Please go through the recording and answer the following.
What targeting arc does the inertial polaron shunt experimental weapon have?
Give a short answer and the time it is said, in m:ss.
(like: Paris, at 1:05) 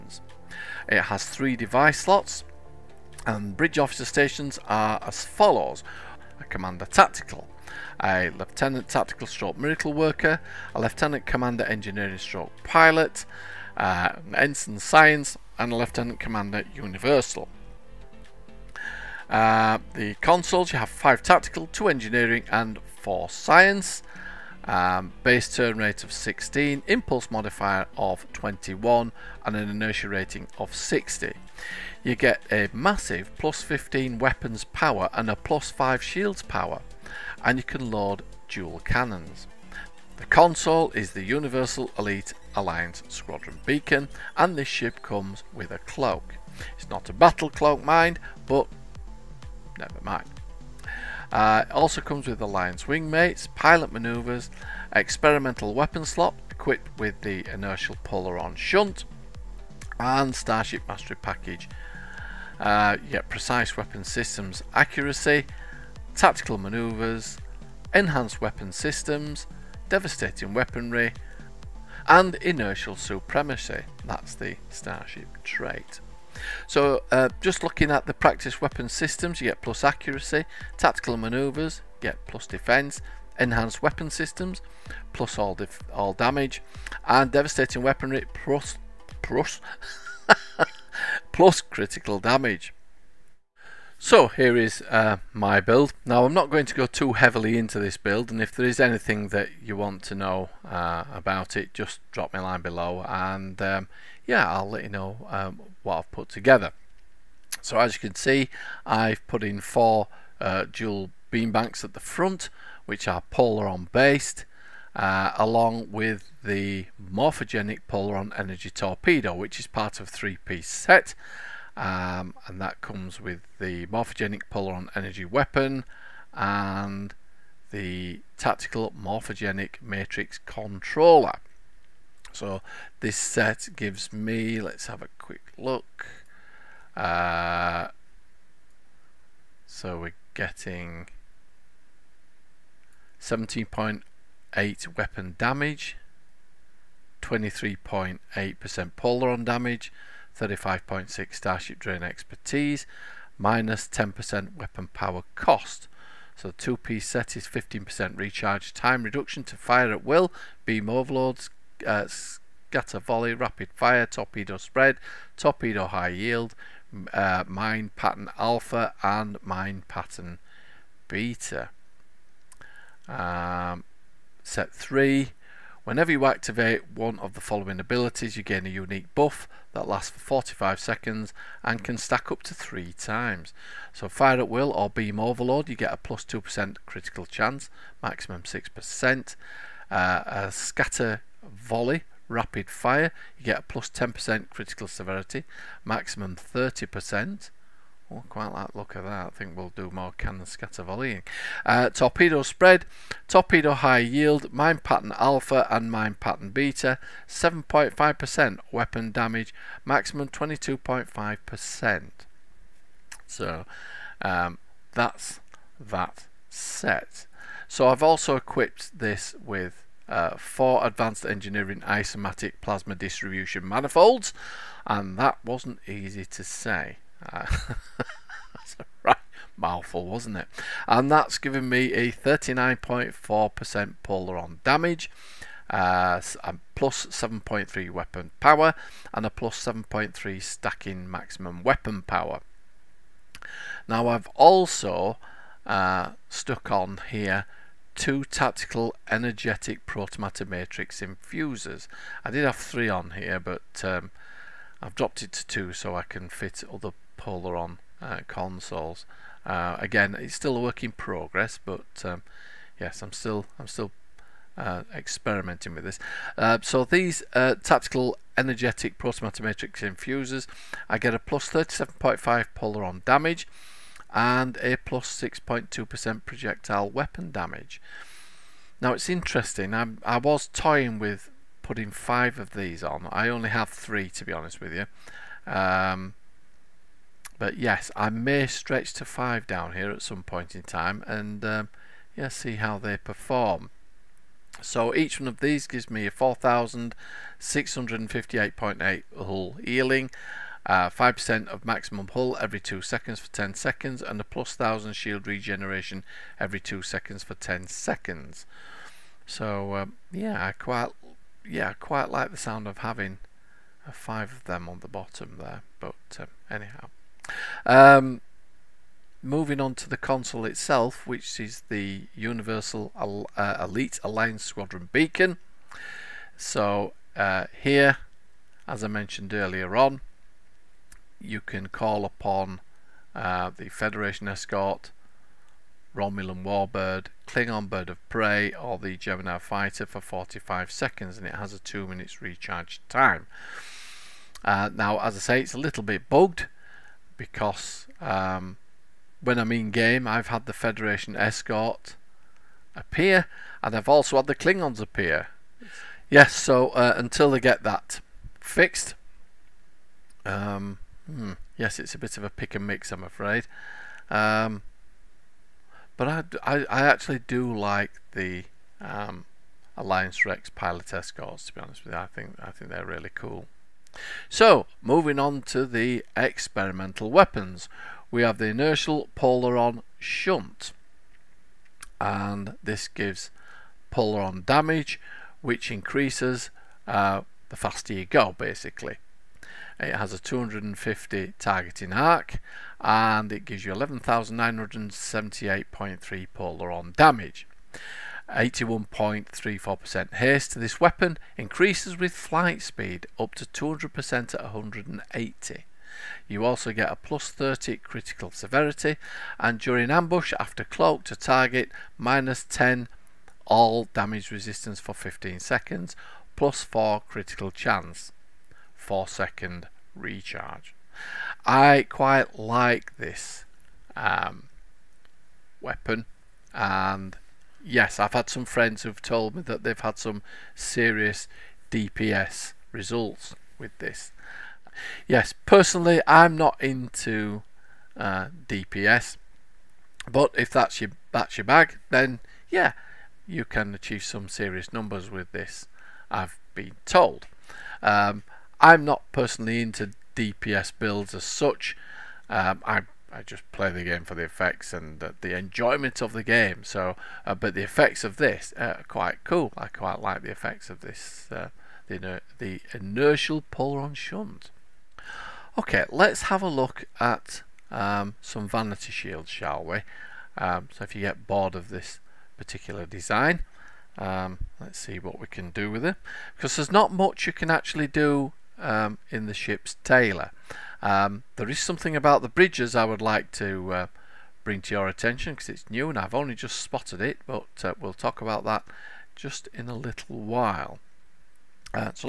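250, at 6:30.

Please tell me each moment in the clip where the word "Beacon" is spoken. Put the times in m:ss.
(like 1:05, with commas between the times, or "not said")
0:43, 5:24.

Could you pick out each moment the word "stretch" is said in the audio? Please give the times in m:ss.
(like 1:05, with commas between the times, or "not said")
4:48.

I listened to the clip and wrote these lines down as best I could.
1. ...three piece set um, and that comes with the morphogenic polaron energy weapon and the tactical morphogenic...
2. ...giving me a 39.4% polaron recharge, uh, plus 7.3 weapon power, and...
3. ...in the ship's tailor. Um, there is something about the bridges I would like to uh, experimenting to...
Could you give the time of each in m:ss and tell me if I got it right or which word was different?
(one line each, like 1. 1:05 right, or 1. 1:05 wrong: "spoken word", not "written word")
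1. 2:00 right
2. 3:51 wrong: "damage", not "recharge"
3. 7:59 wrong: "bring", not "experimenting".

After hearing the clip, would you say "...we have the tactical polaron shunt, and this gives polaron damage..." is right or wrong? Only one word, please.
wrong.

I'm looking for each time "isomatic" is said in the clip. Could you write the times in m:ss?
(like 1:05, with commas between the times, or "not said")
3:41.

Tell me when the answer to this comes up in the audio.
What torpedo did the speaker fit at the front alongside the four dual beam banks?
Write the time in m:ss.
1:57.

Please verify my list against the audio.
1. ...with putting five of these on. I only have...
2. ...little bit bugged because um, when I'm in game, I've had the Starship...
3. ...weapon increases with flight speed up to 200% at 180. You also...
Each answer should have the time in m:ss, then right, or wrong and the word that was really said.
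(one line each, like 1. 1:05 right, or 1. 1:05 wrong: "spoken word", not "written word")
1. 4:40 right
2. 5:45 wrong: "Federation", not "Starship"
3. 6:40 right.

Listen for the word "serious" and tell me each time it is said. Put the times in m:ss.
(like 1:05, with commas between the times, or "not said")
7:10, 7:24.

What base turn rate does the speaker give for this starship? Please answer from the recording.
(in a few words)
16.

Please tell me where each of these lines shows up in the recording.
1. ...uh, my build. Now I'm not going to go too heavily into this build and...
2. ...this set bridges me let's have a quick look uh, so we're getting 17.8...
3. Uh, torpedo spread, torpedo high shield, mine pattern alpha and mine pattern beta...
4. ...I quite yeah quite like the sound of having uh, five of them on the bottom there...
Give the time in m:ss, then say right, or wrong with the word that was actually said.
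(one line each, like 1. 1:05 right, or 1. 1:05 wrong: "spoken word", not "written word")
1. 1:34 right
2. 2:13 wrong: "gives", not "bridges"
3. 3:21 wrong: "yield", not "shield"
4. 5:10 right.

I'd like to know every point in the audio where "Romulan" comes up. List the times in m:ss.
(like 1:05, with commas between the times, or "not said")
5:35.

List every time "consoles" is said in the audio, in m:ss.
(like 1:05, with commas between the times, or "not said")
0:20, 0:40, 4:18, 5:19.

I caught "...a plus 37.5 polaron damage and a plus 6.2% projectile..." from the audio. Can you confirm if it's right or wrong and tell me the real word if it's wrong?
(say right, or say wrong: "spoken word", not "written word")
right.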